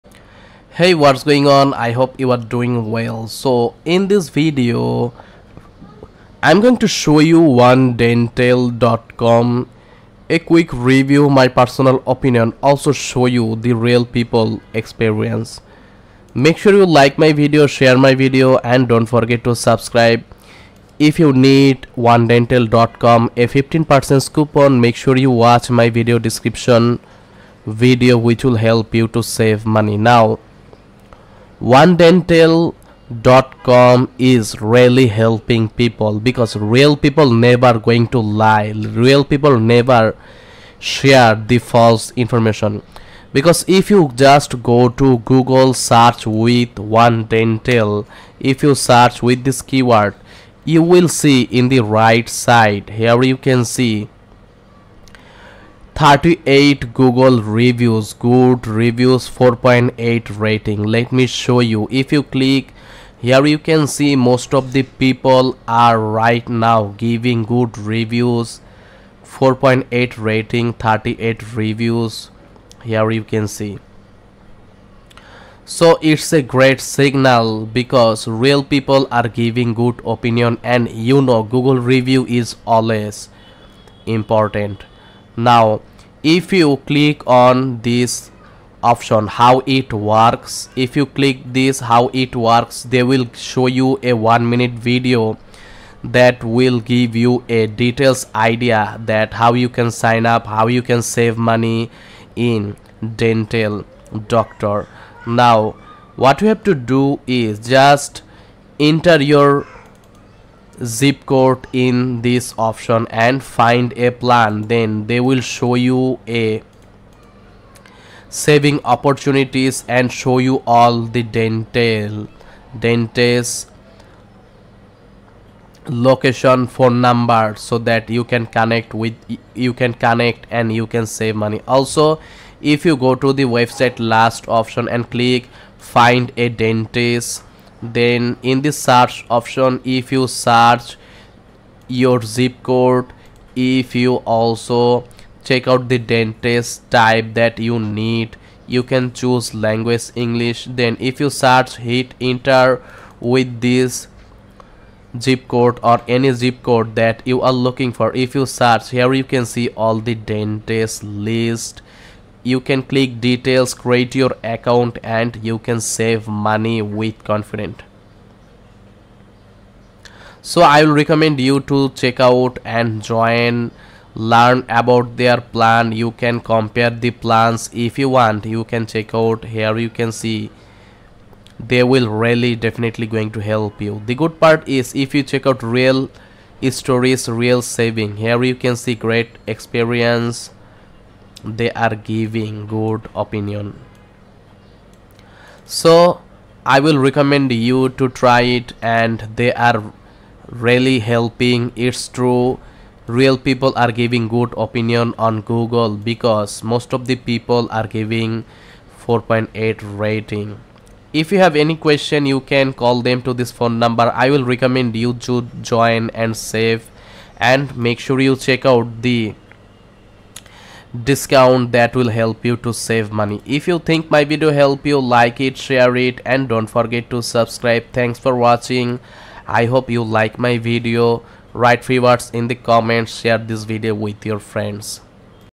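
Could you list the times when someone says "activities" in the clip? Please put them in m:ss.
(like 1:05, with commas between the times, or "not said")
not said.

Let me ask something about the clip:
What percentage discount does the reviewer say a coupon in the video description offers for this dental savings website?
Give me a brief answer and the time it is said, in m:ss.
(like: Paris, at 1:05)
15%, at 0:23.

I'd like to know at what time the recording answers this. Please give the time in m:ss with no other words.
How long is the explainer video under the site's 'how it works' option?
1:34.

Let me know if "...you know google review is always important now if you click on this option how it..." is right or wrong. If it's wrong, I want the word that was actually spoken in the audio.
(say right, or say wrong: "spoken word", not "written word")
right.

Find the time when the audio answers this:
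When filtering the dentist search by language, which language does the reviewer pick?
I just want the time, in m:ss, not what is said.
2:30.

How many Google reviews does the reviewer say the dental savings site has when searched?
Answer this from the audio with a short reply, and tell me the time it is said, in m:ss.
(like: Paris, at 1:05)
38, at 0:56.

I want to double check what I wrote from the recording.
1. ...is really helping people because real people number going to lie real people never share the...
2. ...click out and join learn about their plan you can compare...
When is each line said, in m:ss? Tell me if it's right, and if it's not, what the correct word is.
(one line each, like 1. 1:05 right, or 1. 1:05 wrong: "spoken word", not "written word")
1. 0:34 wrong: "never", not "number"
2. 2:51 wrong: "check", not "click".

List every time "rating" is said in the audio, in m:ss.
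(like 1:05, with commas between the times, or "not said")
1:00, 1:10, 3:29.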